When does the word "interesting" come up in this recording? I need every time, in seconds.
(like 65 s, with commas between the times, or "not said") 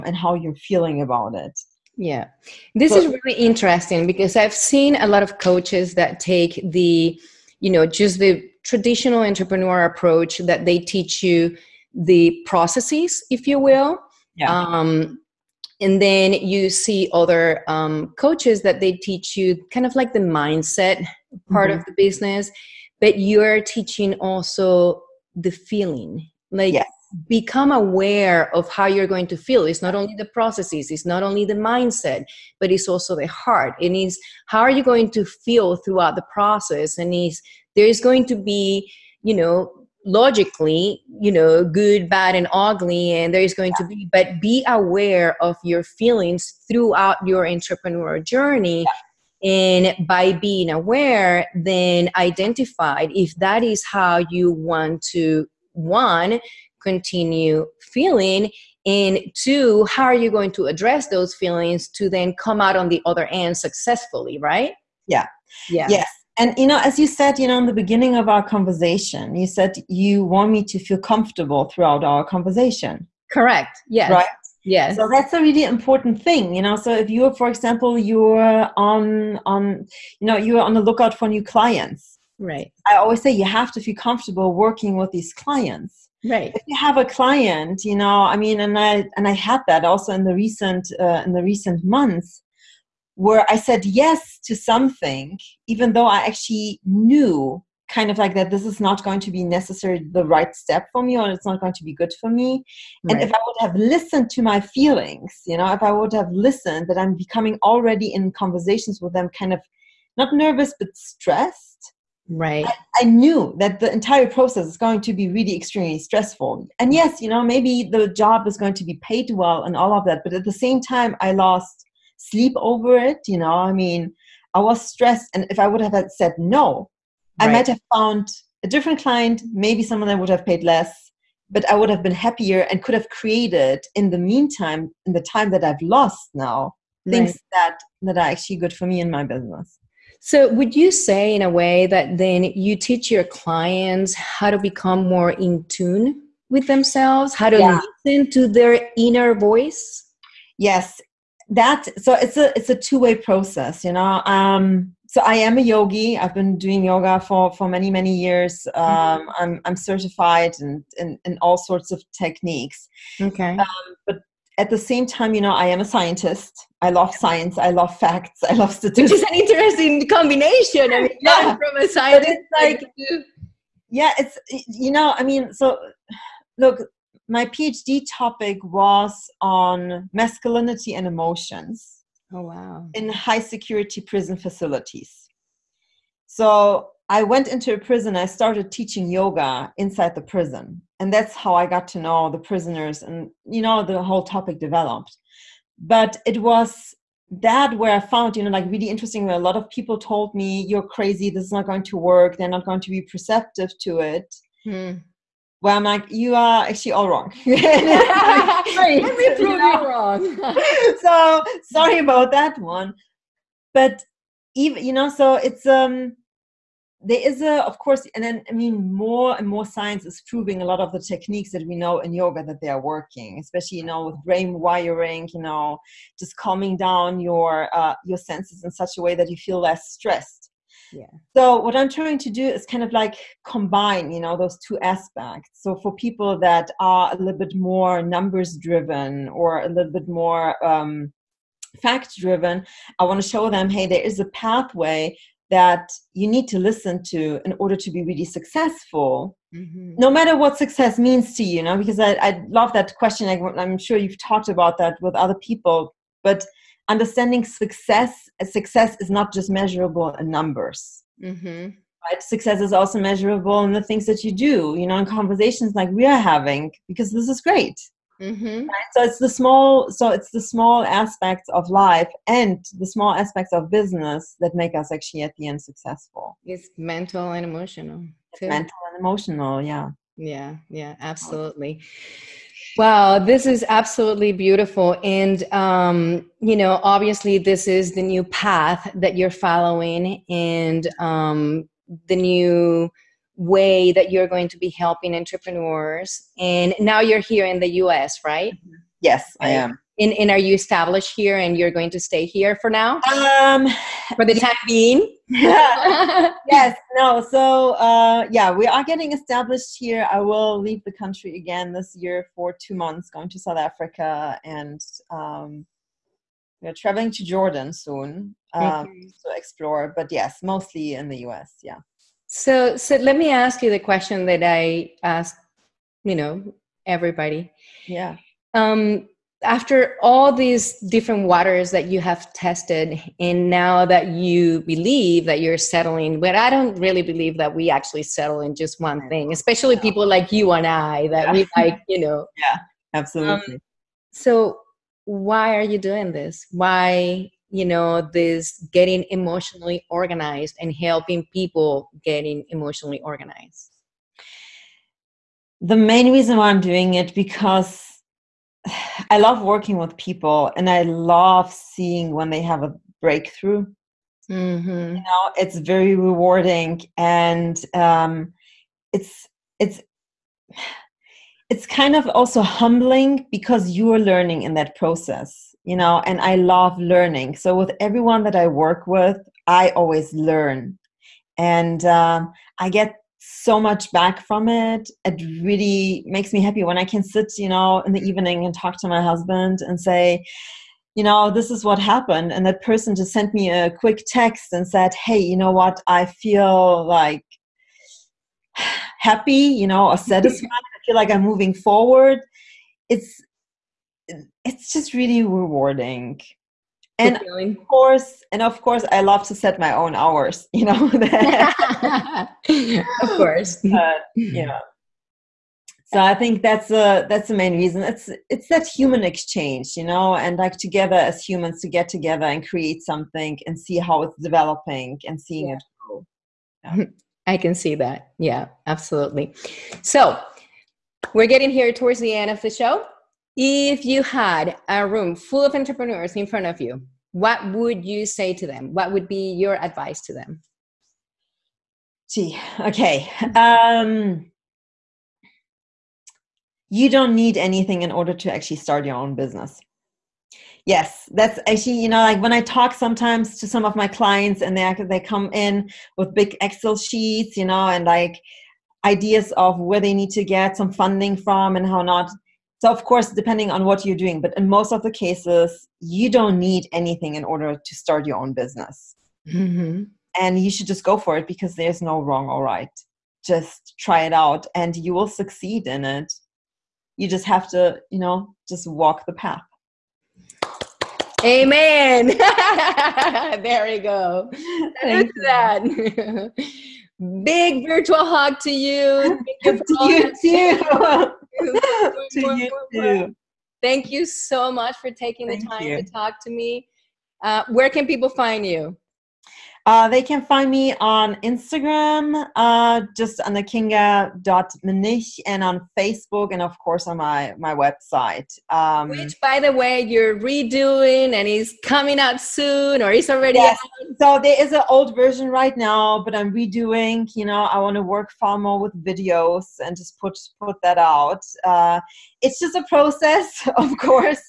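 3 s, 169 s, 198 s.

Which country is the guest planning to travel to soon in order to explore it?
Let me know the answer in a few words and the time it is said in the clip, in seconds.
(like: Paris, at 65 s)
Jordan, at 317 s.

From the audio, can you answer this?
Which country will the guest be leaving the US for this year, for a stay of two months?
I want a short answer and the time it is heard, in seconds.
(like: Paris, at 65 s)
South Africa, at 313 s.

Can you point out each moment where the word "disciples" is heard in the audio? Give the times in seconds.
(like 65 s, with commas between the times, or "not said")
not said.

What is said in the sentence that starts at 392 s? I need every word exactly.
And that person just sent me a quick text and said, hey, you know what?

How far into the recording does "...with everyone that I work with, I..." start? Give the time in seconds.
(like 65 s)
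377 s.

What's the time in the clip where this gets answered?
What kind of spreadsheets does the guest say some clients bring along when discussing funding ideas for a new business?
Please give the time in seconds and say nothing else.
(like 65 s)
456 s.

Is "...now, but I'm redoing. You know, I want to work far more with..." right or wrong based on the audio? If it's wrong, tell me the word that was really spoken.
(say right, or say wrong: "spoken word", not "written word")
right.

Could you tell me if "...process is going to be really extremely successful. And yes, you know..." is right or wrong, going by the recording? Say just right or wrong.
wrong.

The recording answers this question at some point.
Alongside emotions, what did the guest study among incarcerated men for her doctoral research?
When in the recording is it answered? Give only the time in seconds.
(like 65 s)
180 s.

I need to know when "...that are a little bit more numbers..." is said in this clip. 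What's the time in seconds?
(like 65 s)
236 s.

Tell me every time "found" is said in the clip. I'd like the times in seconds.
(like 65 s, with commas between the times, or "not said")
127 s, 197 s.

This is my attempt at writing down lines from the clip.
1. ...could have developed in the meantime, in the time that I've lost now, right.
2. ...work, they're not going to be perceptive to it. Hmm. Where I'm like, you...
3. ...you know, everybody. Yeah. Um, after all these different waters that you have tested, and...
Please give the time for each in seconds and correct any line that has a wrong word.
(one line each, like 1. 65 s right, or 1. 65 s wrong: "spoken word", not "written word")
1. 132 s wrong: "created", not "developed"
2. 201 s right
3. 326 s right.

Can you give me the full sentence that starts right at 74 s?
So that's a really important thing, you know.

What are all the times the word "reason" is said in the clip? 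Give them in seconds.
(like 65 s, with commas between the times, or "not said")
356 s, 417 s.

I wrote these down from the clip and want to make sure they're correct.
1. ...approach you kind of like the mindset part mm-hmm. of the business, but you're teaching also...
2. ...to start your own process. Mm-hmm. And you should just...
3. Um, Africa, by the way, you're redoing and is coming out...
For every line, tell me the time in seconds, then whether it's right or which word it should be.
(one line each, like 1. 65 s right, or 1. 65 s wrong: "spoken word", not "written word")
1. 18 s wrong: "teach", not "approach"
2. 467 s wrong: "business", not "process"
3. 508 s wrong: "Which", not "Africa".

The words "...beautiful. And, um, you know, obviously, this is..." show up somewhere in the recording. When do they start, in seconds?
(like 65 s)
284 s.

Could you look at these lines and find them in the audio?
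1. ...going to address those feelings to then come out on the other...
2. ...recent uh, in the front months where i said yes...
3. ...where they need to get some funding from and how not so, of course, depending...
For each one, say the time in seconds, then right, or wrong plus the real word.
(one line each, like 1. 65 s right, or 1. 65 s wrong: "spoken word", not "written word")
1. 60 s right
2. 90 s wrong: "recent", not "front"
3. 459 s right.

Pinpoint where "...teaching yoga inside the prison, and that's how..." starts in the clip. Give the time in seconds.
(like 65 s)
188 s.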